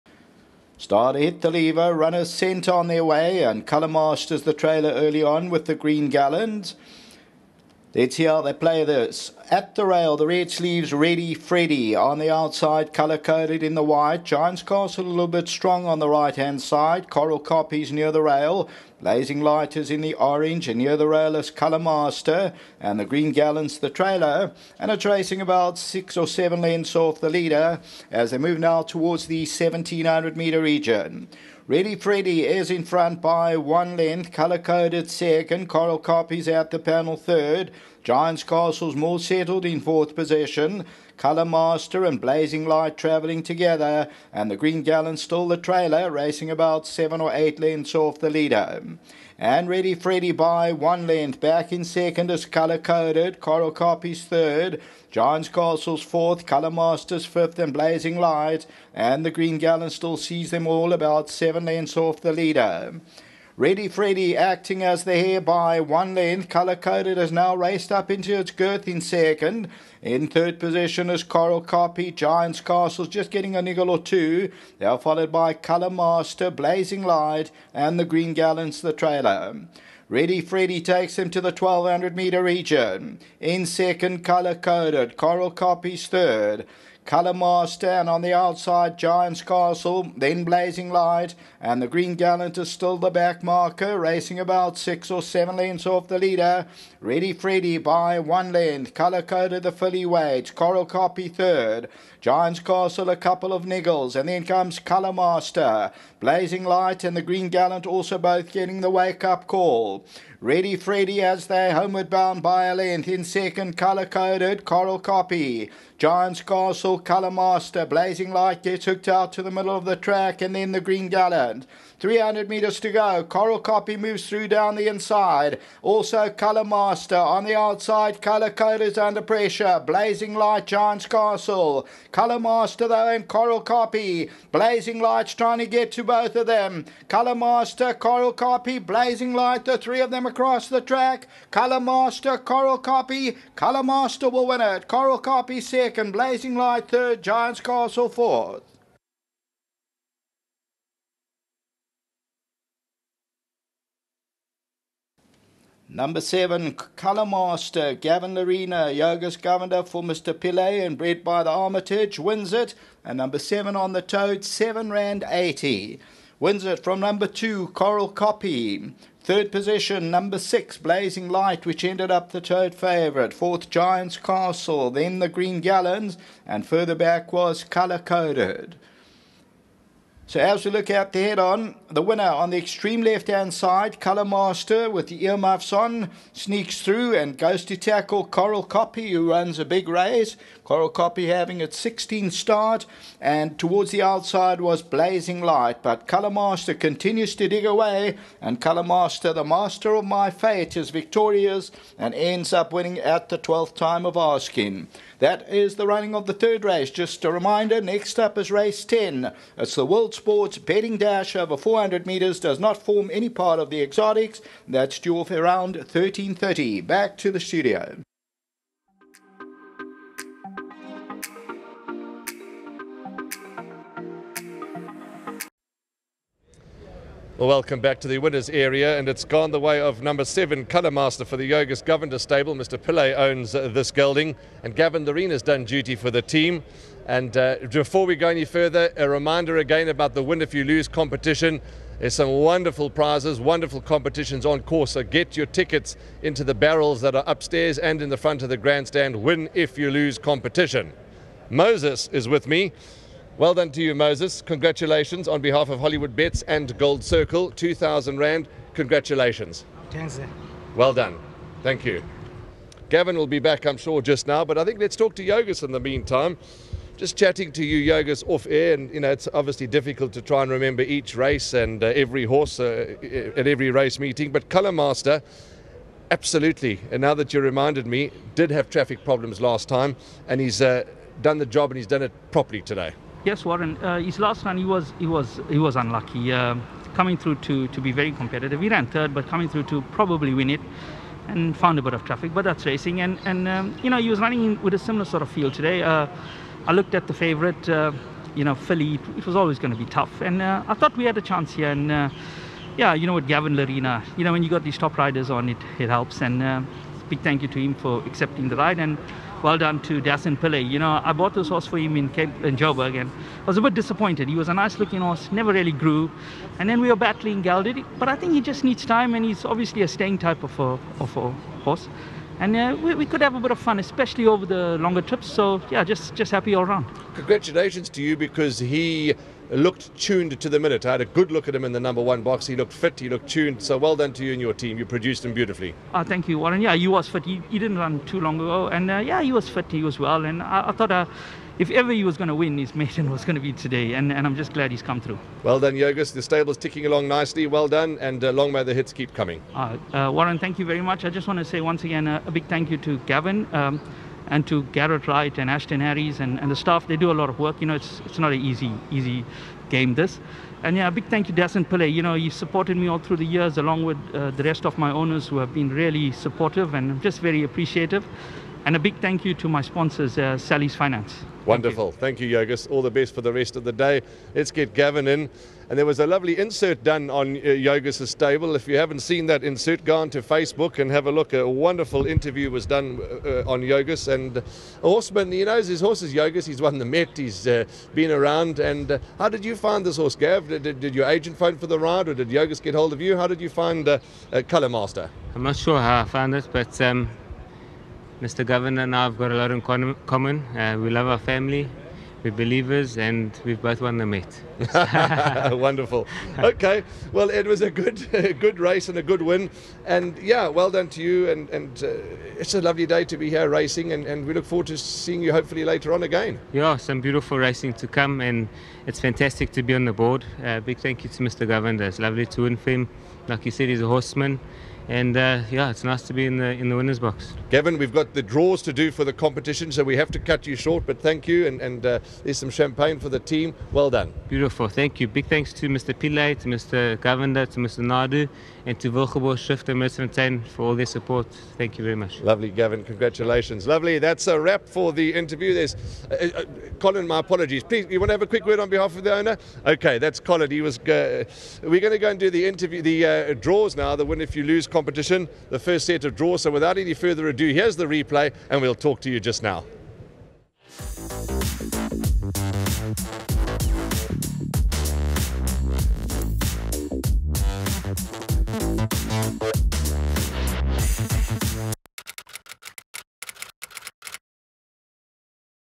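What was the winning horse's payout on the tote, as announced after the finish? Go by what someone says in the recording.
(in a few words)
7 rand 80.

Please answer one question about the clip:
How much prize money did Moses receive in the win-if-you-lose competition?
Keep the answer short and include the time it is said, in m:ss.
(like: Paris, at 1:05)
2,000 Rand, at 4:17.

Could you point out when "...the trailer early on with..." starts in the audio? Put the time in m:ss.
0:04.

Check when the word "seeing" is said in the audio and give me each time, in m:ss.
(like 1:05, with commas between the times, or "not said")
6:54.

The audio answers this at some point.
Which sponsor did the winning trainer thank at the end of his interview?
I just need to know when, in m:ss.
6:10.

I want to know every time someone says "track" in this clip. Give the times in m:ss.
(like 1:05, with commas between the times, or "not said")
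1:59, 2:20.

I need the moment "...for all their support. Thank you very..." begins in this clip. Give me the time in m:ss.
7:20.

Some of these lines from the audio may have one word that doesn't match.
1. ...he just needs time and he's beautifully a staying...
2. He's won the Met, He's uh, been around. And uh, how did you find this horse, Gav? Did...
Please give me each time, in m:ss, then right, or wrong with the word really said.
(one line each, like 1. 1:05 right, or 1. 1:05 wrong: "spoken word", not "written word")
1. 5:18 wrong: "obviously", not "beautifully"
2. 6:26 right.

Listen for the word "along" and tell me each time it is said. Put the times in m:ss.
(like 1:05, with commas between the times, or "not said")
5:46, 6:03.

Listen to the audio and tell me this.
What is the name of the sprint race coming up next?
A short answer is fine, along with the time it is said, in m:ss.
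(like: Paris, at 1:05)
World Sports Betting Dash, 400 metres, at 3:29.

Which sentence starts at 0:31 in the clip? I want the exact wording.
Ready Freddy is in front by one length, color coded second, Coral copies out the panel third.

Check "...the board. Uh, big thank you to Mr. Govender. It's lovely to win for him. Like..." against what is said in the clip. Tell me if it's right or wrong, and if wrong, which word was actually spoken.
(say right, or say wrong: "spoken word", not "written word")
right.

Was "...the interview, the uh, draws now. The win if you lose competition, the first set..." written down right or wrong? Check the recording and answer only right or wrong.
right.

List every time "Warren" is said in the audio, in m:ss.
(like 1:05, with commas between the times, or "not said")
4:43, 5:36, 5:50.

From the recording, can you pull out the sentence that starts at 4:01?
There's some wonderful prizes, wonderful competitions on course.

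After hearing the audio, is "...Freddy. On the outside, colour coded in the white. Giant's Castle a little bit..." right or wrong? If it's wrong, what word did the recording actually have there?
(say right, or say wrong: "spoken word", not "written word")
right.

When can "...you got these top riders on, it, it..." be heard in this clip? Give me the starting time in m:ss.
5:04.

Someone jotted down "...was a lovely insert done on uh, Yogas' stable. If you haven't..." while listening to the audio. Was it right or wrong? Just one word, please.
right.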